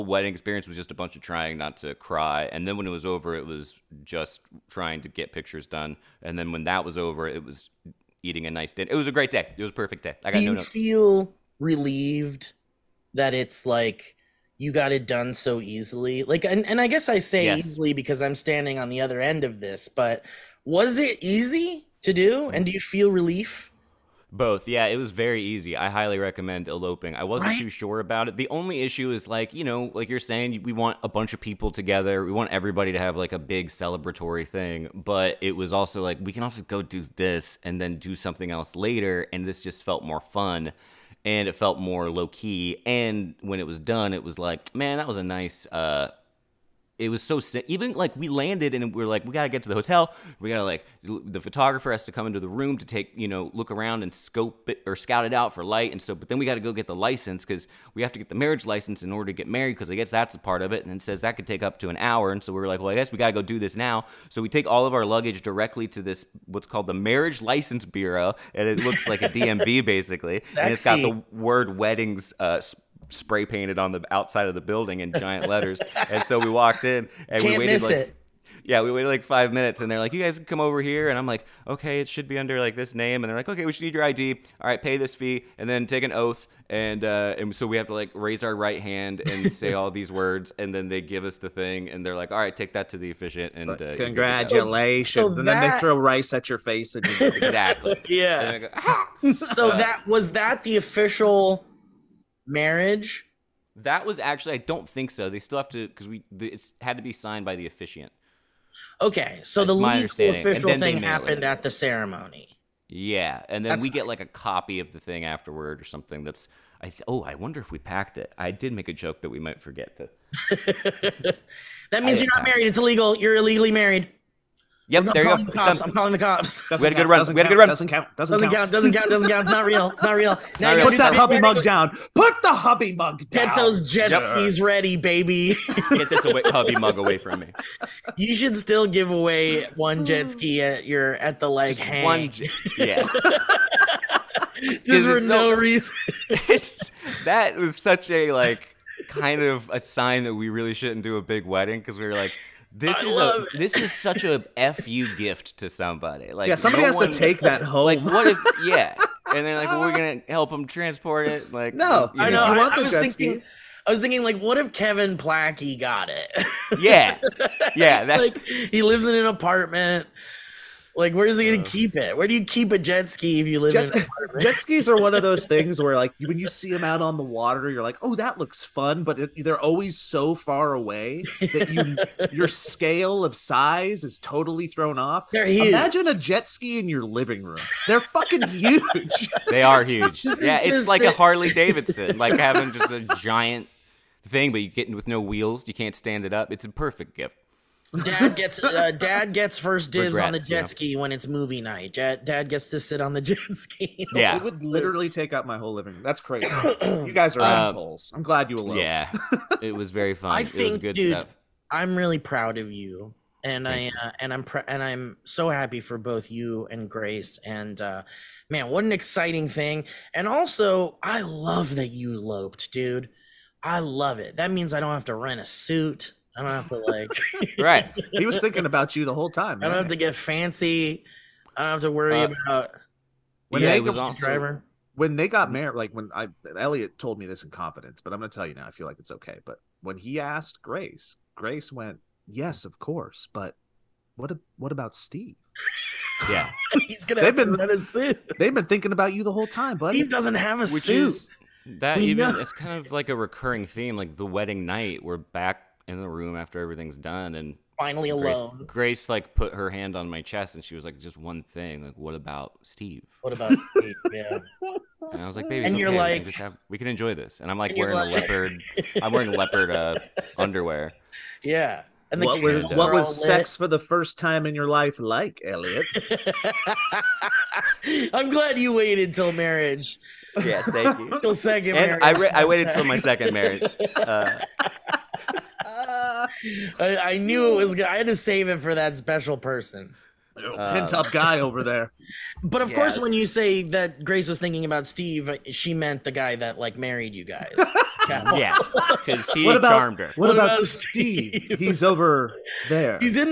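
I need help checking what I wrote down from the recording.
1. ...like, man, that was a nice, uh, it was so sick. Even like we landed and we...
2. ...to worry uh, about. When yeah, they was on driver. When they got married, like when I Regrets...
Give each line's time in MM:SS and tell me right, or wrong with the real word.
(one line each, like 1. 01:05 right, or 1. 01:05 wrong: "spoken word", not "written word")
1. 00:44 right
2. 03:51 wrong: "Elliott", not "Regrets".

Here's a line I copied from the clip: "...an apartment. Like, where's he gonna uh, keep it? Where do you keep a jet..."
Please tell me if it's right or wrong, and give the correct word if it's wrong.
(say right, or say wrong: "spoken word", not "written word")
right.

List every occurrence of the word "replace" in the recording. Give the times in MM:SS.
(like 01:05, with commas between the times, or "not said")
not said.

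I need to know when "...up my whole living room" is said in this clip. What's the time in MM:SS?
03:25.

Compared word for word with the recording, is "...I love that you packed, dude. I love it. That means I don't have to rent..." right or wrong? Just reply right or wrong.
wrong.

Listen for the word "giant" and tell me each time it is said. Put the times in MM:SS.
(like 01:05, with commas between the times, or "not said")
01:15, 03:13.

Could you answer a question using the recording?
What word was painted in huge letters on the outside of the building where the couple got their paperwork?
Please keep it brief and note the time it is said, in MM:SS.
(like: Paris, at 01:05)
weddings, at 01:11.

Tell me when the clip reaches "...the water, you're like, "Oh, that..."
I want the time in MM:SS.
02:57.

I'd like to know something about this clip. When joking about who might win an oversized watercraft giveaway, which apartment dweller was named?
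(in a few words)
Kevin Plachy.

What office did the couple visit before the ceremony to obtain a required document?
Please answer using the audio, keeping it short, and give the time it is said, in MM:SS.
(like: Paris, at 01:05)
marriage license bureau, at 01:06.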